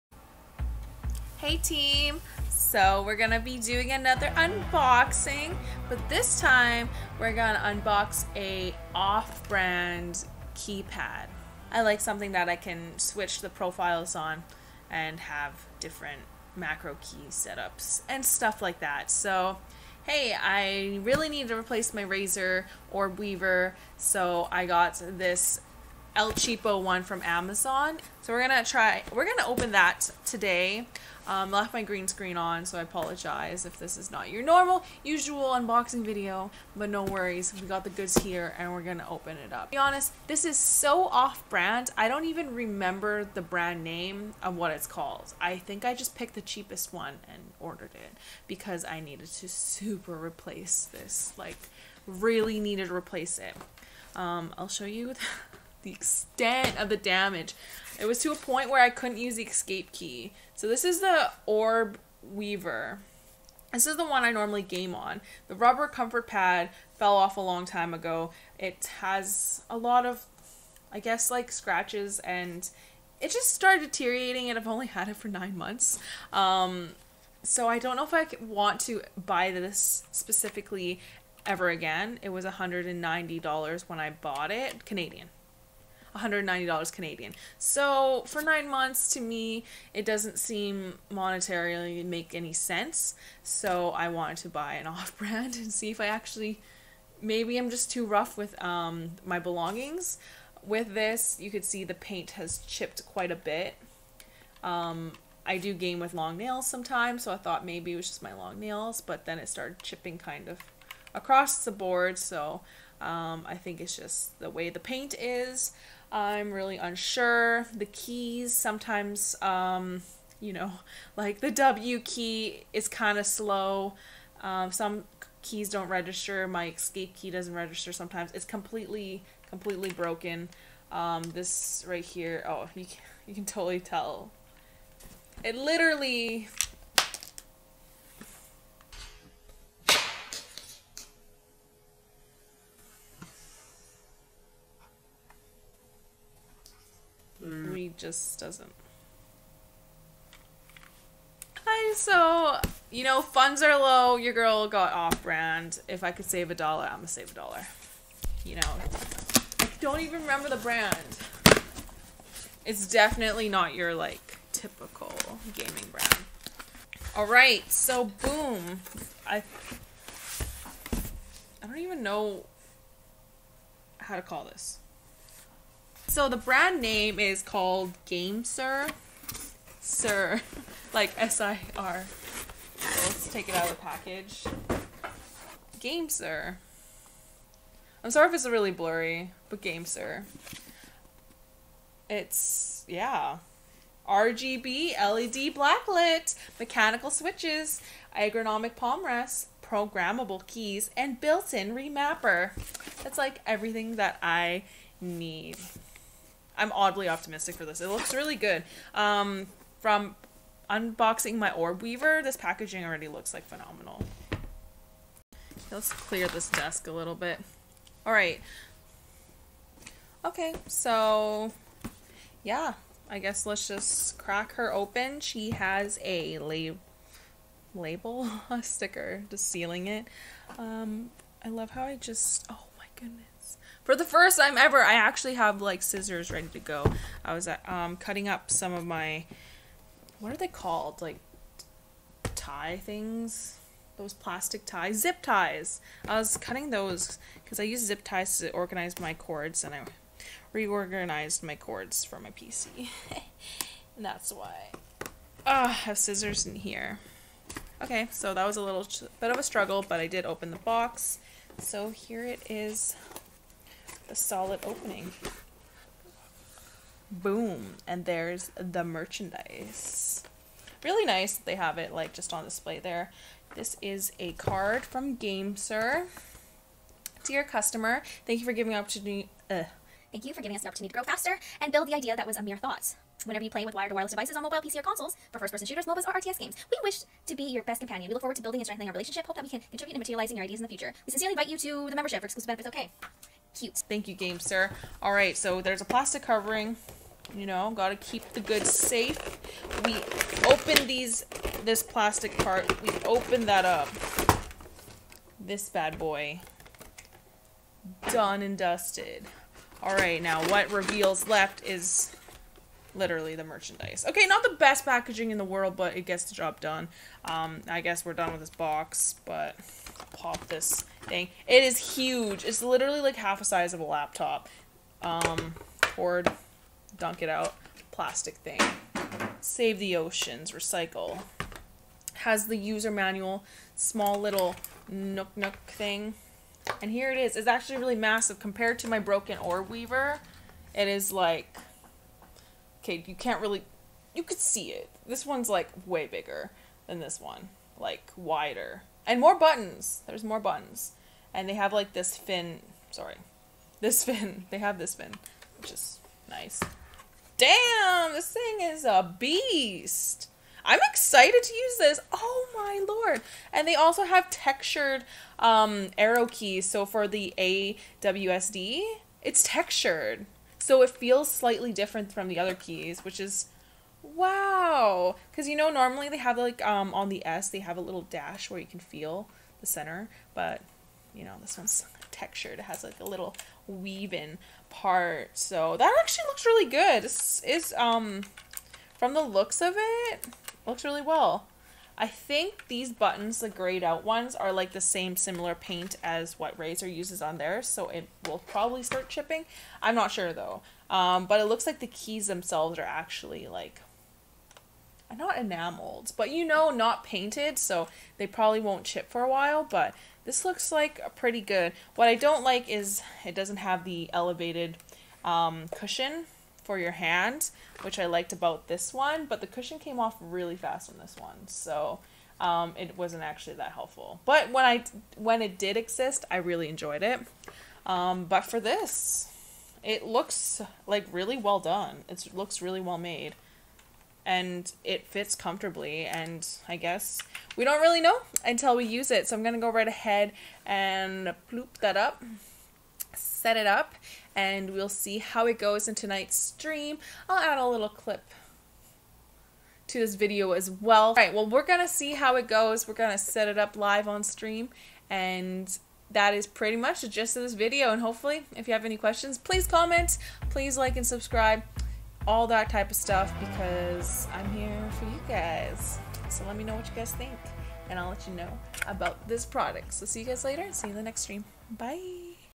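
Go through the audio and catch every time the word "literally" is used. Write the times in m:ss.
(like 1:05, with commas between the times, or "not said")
2:15, 5:12, 5:22.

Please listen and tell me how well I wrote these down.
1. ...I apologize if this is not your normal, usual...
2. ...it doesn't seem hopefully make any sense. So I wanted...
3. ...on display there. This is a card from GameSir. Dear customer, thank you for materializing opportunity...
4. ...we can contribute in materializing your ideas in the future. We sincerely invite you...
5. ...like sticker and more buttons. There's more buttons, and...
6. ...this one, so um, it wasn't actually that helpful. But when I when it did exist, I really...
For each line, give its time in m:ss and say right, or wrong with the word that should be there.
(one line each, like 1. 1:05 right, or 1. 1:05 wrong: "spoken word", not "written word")
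1. 0:32 right
2. 1:29 wrong: "monetarily", not "hopefully"
3. 4:32 wrong: "giving", not "materializing"
4. 4:49 right
5. 5:47 wrong: "wider", not "sticker"
6. 7:00 right.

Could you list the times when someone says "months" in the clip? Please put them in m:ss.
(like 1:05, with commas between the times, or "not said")
1:15, 1:28.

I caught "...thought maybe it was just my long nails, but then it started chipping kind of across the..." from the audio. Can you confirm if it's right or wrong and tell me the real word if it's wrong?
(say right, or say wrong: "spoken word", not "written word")
right.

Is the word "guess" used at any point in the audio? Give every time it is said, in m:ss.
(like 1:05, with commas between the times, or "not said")
1:10, 3:43, 5:17, 7:16.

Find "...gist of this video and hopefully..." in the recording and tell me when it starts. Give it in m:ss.
7:37.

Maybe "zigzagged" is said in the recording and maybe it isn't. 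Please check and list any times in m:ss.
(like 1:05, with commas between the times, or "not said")
not said.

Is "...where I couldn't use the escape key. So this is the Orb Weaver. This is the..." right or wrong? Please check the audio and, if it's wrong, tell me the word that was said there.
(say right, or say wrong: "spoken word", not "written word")
right.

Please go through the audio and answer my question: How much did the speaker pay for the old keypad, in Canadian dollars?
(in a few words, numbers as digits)
$190.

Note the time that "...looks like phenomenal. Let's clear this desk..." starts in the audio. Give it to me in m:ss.
3:33.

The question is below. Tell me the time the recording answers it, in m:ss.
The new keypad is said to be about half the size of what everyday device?
5:23.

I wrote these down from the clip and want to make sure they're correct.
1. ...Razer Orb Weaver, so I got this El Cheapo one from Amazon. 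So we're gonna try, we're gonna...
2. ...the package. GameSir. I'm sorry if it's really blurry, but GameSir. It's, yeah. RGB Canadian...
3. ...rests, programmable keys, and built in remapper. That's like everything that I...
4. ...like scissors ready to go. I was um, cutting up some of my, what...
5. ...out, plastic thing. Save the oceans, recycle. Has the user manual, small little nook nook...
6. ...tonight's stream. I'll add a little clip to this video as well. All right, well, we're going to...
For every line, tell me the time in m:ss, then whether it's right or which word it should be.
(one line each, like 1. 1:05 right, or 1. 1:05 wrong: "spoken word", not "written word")
1. 0:22 right
2. 3:03 wrong: "LED", not "Canadian"
3. 3:19 right
4. 3:55 right
5. 5:27 right
6. 7:25 right.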